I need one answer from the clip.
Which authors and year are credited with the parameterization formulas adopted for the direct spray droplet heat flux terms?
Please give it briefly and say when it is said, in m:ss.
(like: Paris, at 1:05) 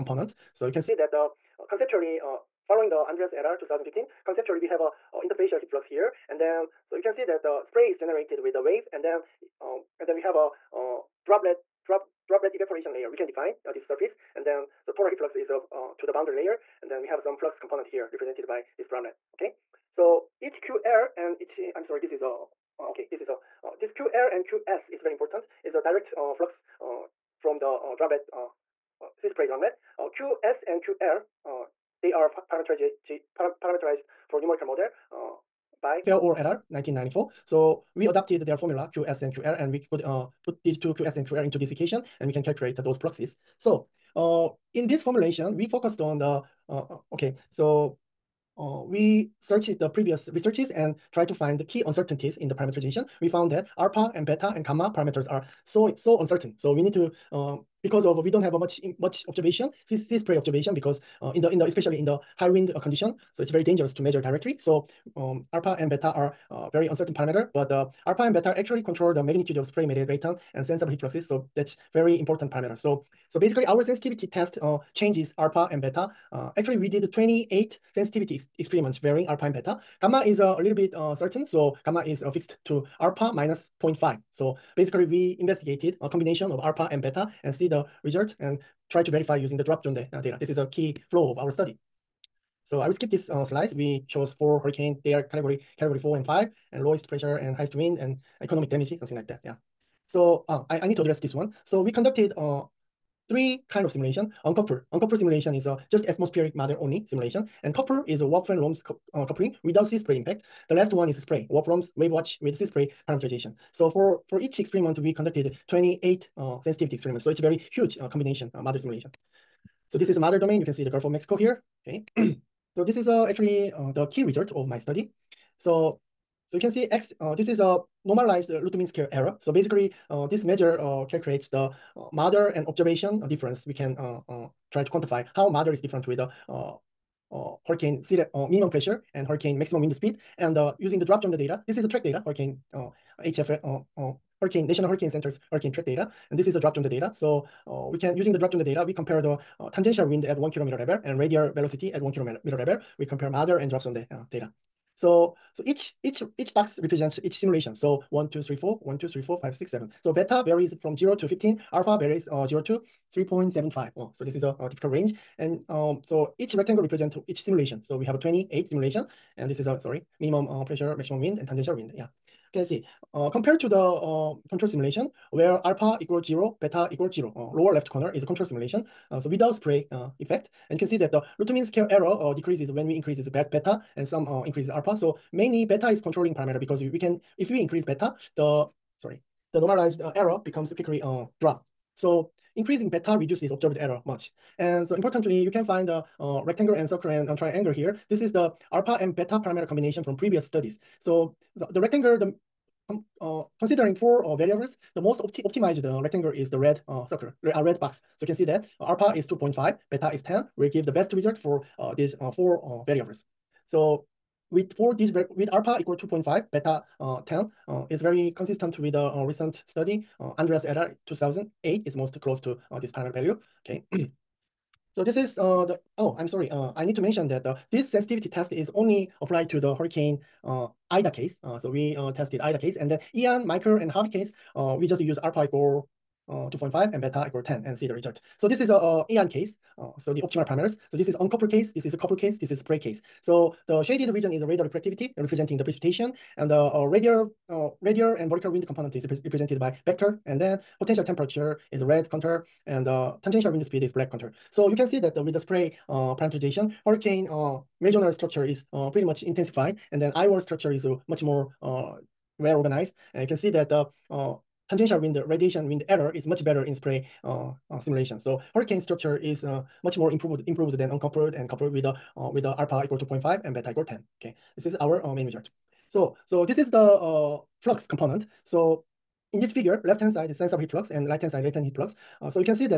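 Fairall et al. 1994, at 0:36.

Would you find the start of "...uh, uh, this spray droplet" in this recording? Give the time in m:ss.
0:28.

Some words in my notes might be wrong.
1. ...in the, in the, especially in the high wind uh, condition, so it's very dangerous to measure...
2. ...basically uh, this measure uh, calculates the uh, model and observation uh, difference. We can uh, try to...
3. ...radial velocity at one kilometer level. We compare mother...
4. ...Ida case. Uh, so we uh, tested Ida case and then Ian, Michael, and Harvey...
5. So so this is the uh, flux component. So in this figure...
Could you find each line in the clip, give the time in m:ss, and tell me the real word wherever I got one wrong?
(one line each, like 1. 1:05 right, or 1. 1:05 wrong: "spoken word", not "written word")
1. 1:01 right
2. 2:09 right
3. 2:31 right
4. 3:50 right
5. 4:35 right.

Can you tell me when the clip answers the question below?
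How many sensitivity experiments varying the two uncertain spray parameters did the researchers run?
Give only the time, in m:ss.
1:17.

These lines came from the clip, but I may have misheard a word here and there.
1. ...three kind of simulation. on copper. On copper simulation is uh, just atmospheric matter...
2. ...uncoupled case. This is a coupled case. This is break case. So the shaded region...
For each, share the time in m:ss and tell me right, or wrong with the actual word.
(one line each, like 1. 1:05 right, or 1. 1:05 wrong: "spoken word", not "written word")
1. 1:43 right
2. 4:01 right.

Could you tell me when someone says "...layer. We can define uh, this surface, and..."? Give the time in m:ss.
0:12.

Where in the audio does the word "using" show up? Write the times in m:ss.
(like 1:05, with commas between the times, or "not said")
1:29, 2:20, 2:28.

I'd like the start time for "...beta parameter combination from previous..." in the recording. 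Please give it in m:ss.
3:19.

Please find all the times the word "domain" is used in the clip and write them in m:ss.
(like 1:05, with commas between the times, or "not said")
2:00.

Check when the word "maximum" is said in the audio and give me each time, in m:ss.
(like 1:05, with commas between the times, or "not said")
2:19, 2:50.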